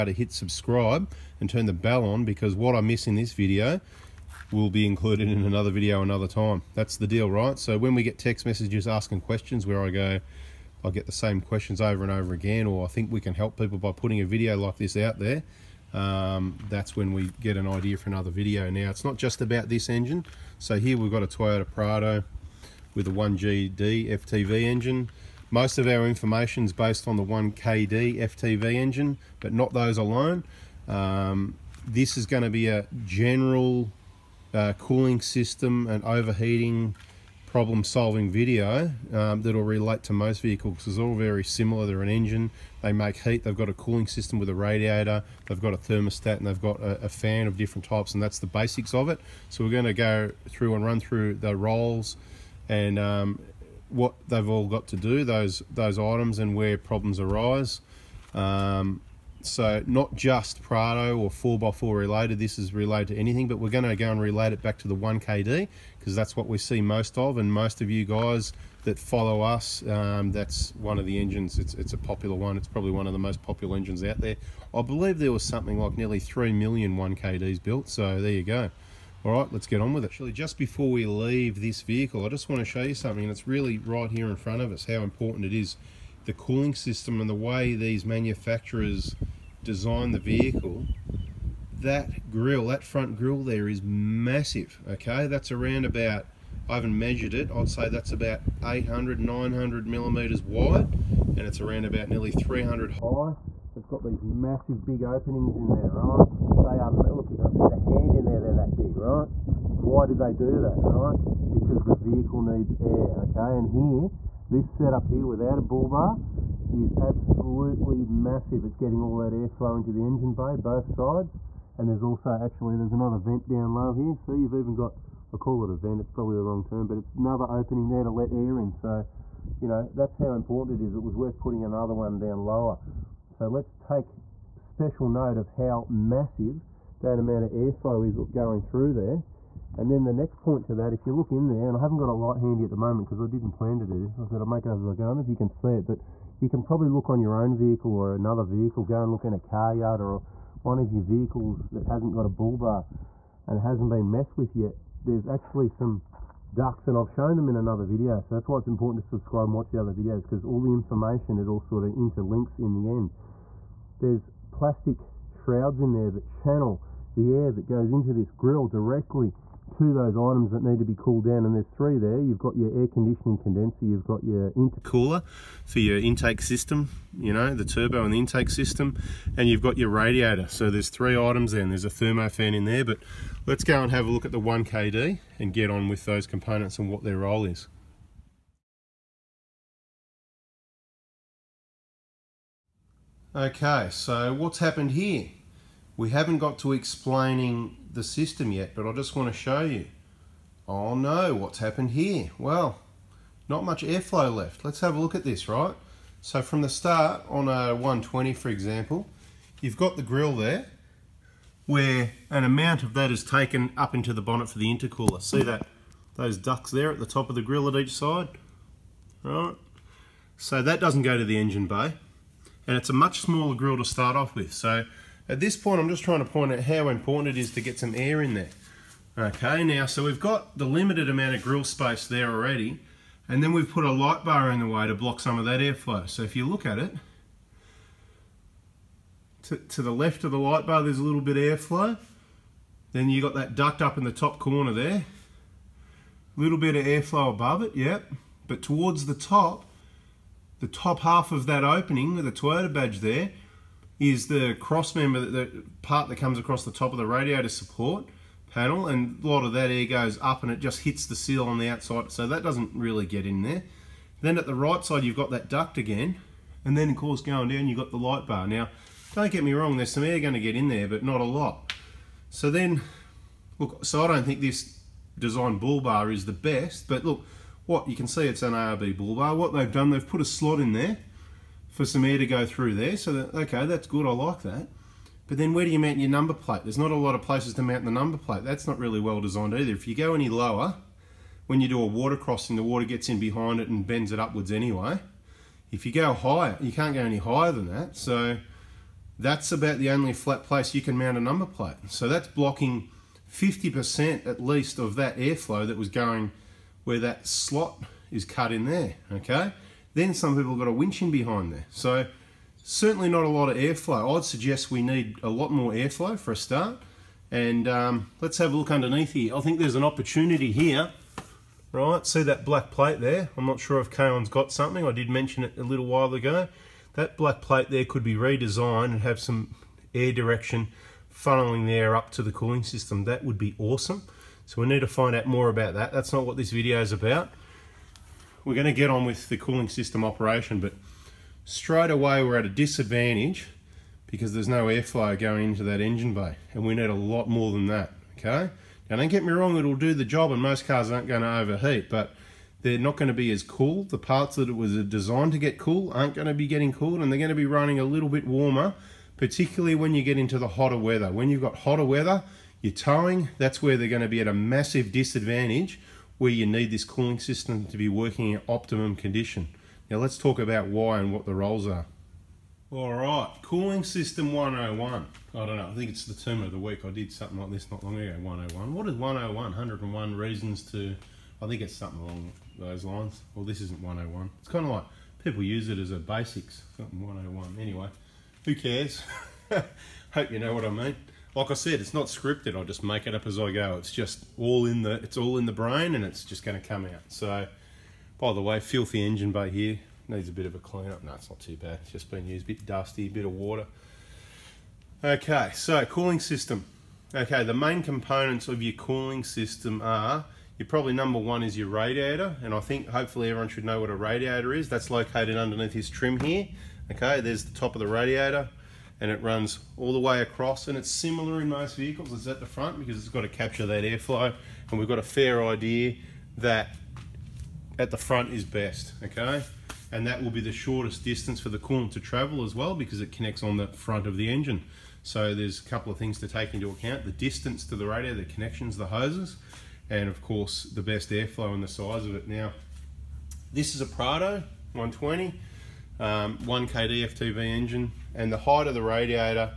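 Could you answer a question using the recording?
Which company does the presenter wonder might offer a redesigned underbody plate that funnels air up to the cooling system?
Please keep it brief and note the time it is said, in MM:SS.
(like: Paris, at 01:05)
Kaon, at 05:23.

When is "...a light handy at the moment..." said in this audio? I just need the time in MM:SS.
02:22.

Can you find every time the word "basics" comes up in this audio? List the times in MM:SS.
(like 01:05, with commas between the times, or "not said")
00:48, 06:25.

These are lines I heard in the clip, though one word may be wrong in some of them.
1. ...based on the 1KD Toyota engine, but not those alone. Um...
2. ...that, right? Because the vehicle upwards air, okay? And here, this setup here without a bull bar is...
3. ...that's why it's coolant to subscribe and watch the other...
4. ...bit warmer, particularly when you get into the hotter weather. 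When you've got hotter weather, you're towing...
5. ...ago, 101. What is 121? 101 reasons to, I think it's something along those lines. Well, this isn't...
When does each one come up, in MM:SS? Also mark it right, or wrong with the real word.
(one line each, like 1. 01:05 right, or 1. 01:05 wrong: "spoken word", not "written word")
1. 00:26 wrong: "FTV", not "Toyota"
2. 01:50 wrong: "needs", not "upwards"
3. 02:38 wrong: "important", not "coolant"
4. 05:58 right
5. 06:17 wrong: "101", not "121".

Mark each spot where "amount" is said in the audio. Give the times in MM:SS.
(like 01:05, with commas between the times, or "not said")
02:17, 03:32, 03:51.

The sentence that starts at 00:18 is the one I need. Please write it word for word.
Now, it's not just about this engine.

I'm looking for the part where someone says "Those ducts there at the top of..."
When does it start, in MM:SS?
03:36.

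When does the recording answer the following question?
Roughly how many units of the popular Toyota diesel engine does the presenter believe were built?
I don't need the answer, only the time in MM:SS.
01:15.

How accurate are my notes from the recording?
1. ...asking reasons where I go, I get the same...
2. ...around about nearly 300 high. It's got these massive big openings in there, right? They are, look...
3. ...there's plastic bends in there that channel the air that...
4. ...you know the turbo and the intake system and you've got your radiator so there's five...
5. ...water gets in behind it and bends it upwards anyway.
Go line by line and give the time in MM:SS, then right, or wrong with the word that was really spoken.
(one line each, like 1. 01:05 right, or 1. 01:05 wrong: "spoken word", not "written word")
1. 00:08 wrong: "questions", not "reasons"
2. 01:41 right
3. 02:43 wrong: "shrouds", not "bends"
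4. 02:57 wrong: "three", not "five"
5. 04:52 right.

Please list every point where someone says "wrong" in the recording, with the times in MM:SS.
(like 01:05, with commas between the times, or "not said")
02:06, 04:29, 05:49.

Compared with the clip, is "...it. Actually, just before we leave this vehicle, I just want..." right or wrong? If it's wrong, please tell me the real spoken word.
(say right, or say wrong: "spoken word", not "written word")
right.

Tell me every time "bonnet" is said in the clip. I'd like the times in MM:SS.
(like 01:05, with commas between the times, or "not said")
03:34.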